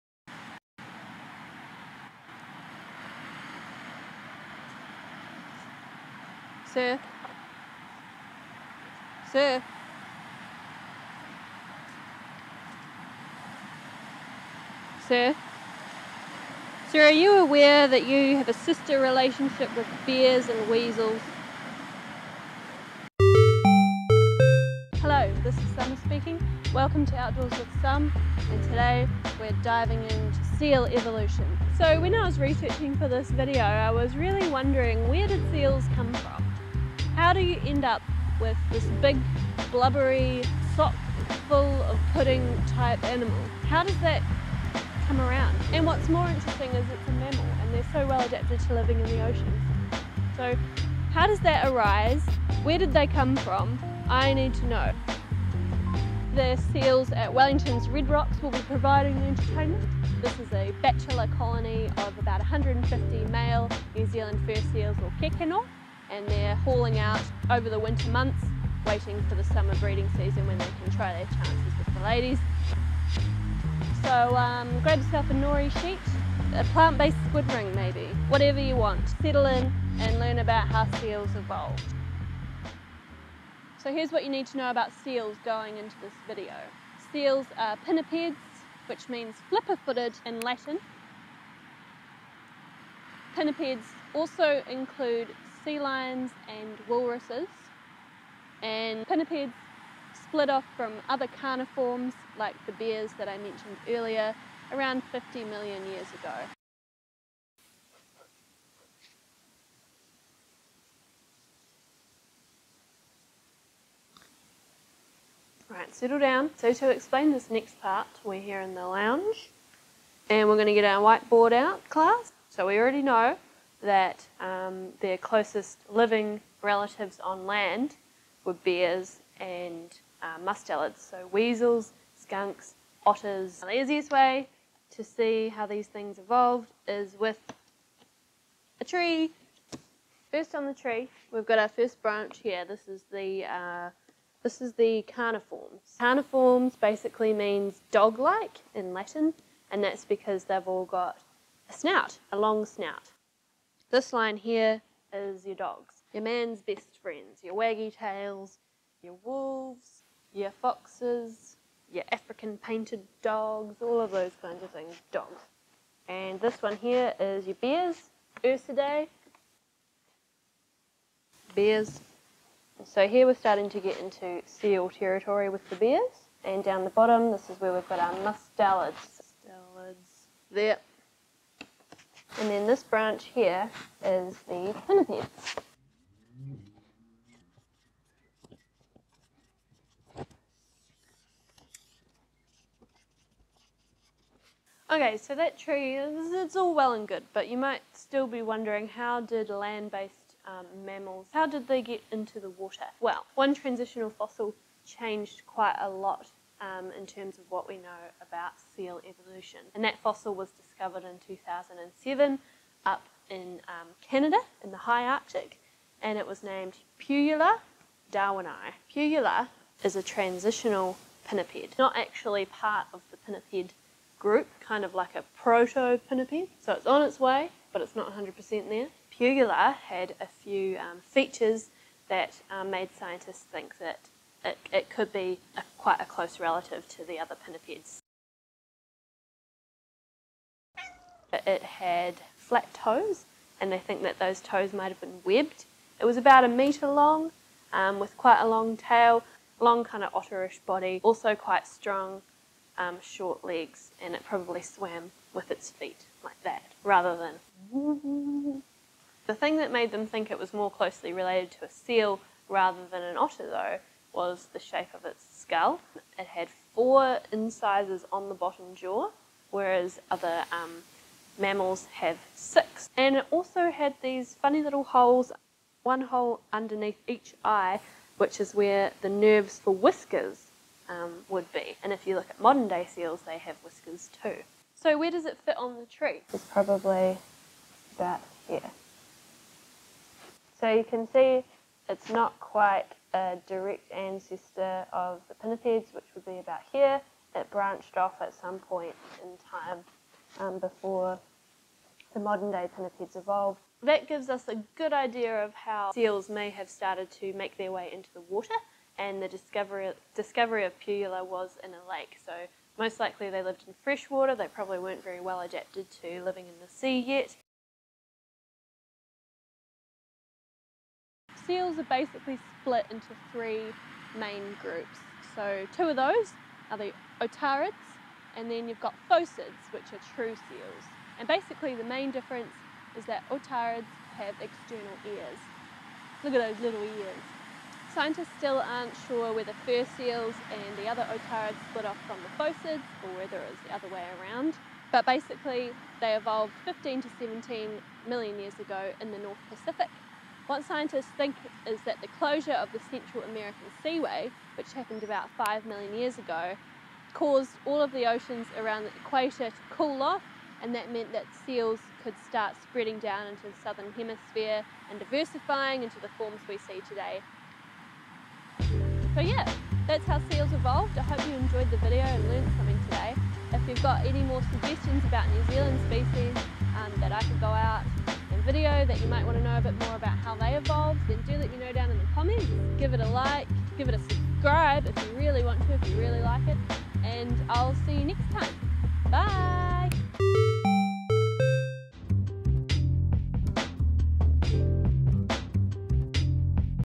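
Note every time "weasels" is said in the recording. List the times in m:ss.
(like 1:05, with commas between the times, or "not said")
0:20, 2:11.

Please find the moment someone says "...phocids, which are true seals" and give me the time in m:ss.
5:29.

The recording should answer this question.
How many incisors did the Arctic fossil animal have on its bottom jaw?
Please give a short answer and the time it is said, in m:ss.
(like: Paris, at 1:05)
4, at 4:26.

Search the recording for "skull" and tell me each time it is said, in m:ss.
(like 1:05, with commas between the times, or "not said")
4:25.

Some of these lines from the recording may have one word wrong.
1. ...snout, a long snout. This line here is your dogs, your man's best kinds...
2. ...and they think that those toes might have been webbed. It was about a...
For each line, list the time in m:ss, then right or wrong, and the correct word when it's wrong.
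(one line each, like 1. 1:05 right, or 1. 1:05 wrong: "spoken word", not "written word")
1. 2:31 wrong: "friends", not "kinds"
2. 4:03 right.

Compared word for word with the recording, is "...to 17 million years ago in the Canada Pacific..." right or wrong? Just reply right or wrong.
wrong.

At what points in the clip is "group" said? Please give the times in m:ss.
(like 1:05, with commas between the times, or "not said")
3:44, 5:24.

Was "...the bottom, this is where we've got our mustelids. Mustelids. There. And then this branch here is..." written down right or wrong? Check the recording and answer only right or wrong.
right.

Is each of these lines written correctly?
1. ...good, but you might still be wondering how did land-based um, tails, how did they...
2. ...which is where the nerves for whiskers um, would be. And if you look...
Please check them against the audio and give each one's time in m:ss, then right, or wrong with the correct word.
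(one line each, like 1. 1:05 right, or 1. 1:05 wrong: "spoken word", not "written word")
1. 3:17 wrong: "mammals", not "tails"
2. 4:38 right.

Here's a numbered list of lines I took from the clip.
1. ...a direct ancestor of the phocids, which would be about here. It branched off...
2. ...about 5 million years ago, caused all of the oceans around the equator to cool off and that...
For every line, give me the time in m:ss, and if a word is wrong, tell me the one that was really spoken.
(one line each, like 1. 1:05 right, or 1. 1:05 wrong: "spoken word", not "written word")
1. 4:53 wrong: "pinnipeds", not "phocids"
2. 5:55 right.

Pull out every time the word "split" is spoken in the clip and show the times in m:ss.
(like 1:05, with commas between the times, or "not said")
1:40, 5:22, 5:41.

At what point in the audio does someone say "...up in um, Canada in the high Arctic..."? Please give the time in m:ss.
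3:32.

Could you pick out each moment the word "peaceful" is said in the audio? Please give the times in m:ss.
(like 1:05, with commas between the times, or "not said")
not said.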